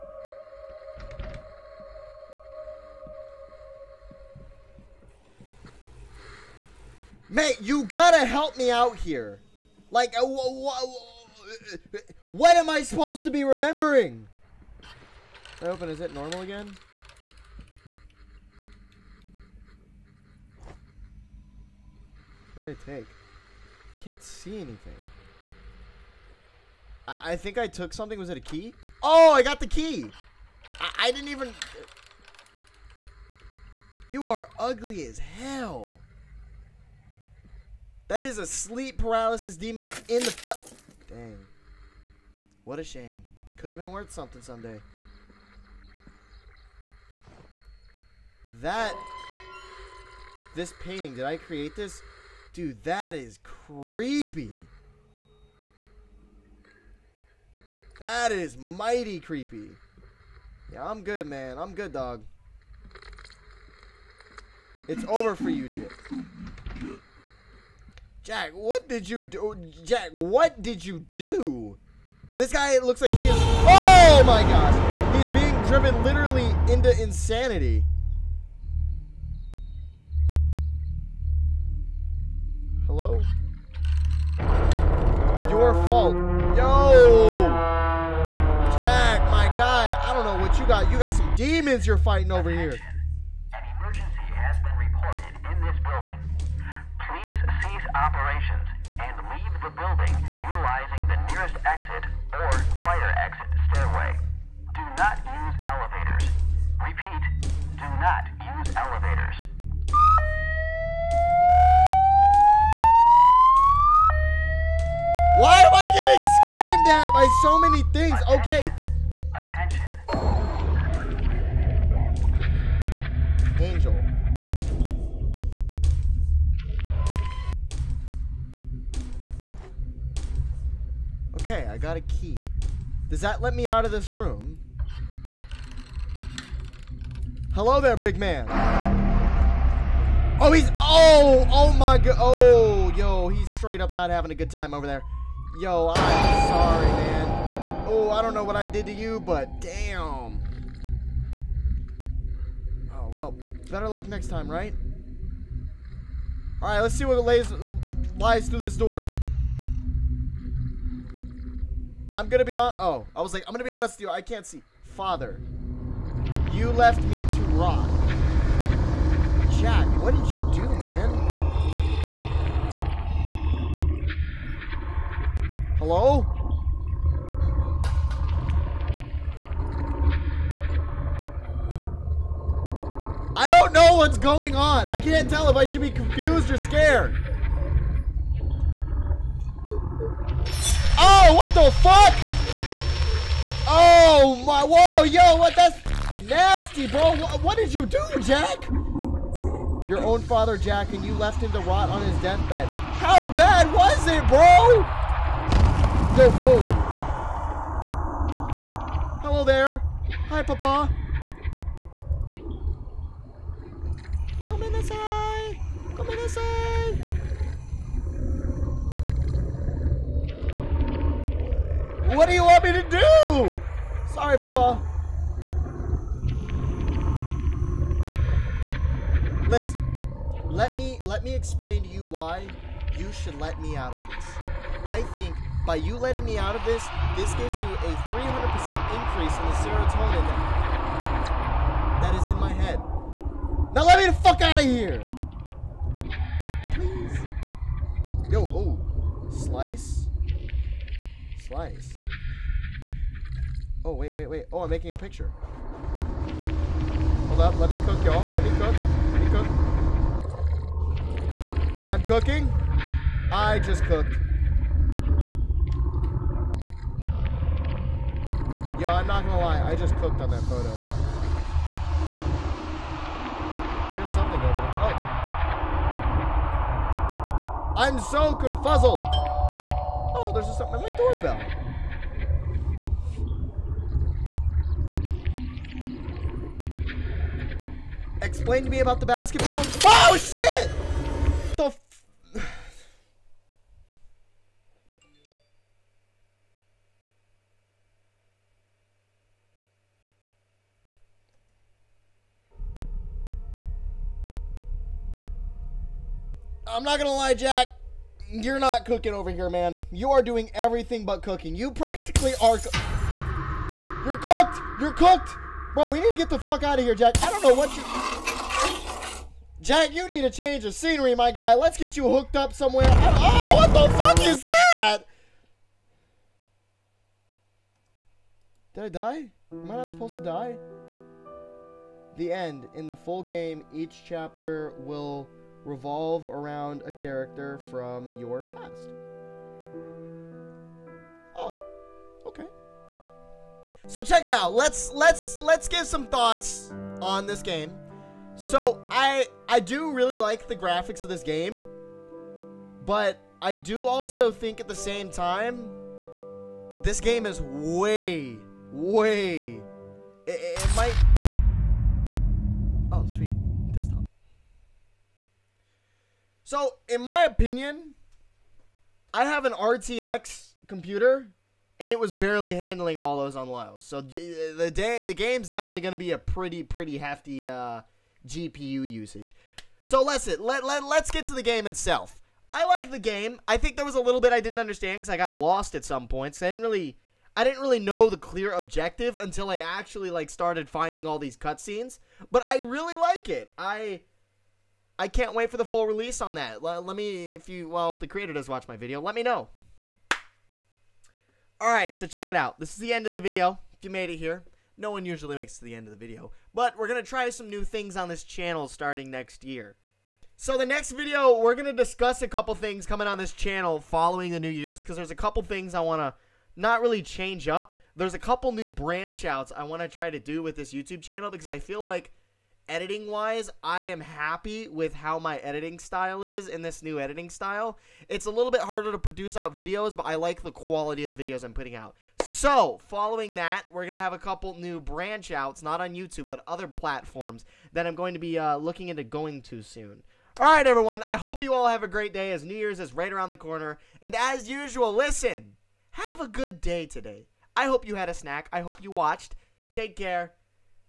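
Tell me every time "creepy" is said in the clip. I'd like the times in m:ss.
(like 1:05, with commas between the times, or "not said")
0:53, 0:59.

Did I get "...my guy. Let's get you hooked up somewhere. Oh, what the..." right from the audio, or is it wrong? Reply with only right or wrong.
right.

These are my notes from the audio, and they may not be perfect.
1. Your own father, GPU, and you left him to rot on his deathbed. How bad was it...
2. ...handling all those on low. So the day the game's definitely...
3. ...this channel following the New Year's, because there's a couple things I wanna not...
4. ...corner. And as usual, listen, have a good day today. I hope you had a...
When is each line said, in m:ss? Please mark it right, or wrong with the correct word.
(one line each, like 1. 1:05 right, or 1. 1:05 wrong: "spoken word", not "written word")
1. 3:19 wrong: "Jack", not "GPU"
2. 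6:12 right
3. 6:53 right
4. 7:23 right.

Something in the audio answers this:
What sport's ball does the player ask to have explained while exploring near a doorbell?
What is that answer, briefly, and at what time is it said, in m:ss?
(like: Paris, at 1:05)
basketball, at 4:49.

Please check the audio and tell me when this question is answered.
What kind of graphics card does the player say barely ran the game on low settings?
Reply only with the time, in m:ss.
6:09.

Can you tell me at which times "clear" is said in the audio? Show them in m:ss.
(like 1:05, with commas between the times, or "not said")
6:28.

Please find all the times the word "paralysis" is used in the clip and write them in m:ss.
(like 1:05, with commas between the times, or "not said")
0:38.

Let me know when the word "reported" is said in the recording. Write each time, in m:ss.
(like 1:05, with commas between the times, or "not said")
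1:34.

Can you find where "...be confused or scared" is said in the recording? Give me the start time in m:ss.
3:05.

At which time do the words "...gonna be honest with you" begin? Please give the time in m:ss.
2:43.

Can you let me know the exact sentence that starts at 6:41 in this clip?
All right, so check it out.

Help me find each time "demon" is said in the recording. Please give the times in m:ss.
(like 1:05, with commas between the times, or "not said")
0:39, 1:31.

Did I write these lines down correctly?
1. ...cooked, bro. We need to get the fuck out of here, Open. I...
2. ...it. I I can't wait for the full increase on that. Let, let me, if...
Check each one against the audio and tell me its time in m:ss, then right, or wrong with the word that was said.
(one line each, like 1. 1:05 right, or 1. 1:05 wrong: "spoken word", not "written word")
1. 5:14 wrong: "Jack", not "Open"
2. 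6:33 wrong: "release", not "increase".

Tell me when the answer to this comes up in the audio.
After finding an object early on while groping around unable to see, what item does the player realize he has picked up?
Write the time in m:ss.
0:29.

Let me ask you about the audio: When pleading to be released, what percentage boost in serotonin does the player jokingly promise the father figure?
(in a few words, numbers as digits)
300%.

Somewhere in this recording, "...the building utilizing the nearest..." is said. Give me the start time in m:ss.
1:39.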